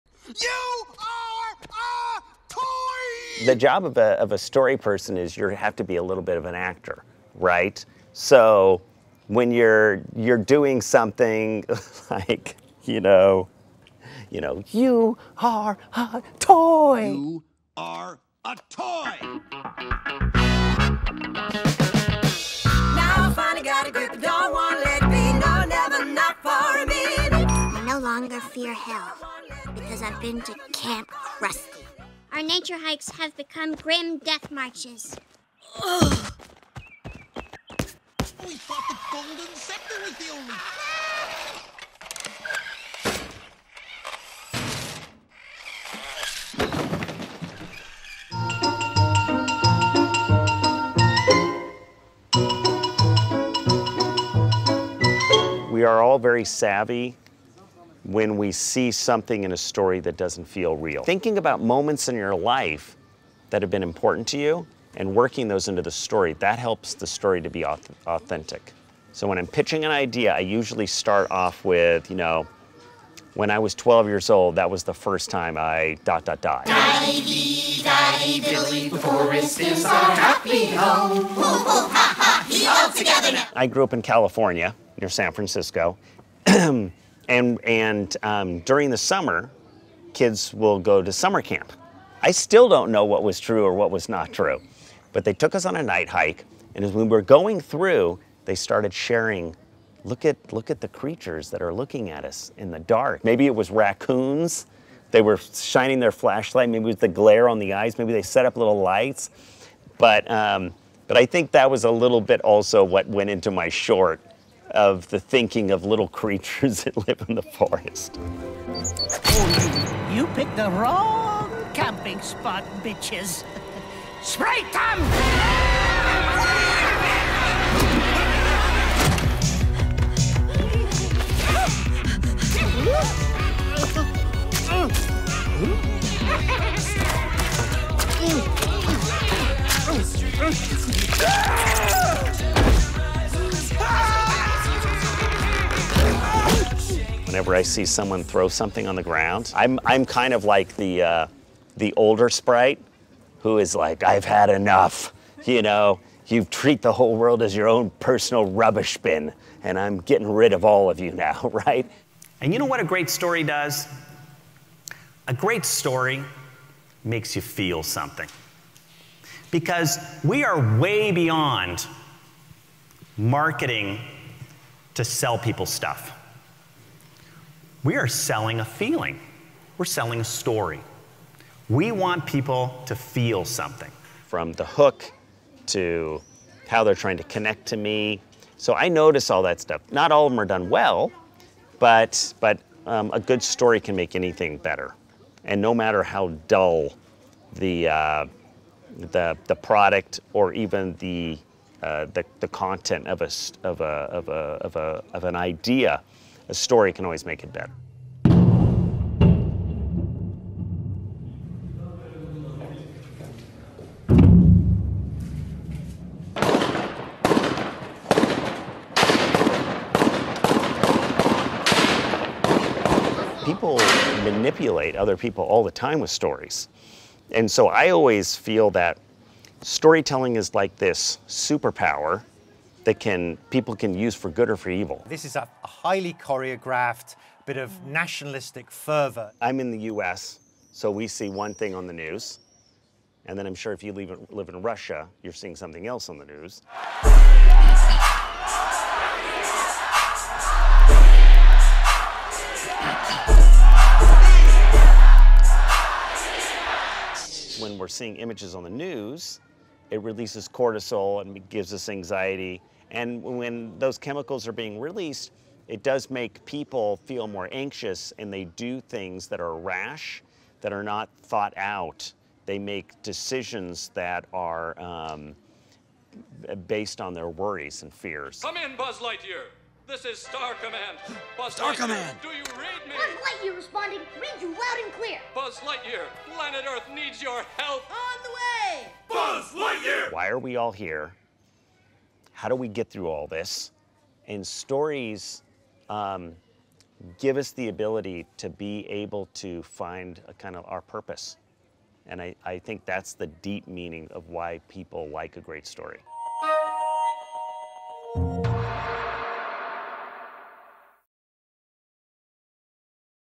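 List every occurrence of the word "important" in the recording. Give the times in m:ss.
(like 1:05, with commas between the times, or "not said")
1:03.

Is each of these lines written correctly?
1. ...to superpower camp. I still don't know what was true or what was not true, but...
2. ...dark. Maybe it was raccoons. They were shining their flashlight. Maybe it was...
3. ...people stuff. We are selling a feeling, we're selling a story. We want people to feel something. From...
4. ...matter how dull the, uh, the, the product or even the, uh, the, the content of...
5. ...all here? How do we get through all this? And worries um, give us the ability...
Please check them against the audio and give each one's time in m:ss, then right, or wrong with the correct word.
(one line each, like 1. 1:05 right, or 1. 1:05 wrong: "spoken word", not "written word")
1. 1:31 wrong: "summer", not "superpower"
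2. 1:42 right
3. 2:55 right
4. 3:15 right
5. 4:50 wrong: "stories", not "worries".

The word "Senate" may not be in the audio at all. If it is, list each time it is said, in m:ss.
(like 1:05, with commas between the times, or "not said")
not said.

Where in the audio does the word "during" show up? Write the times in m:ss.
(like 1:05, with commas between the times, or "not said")
1:28.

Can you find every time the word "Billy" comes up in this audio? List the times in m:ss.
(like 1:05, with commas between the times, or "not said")
1:18.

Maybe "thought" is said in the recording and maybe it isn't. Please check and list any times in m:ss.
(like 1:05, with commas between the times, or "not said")
0:38, 4:31.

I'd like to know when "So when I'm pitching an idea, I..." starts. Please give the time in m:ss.
1:09.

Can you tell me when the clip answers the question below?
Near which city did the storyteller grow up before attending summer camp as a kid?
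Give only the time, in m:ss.
1:25.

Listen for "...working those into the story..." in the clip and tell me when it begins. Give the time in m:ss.
1:05.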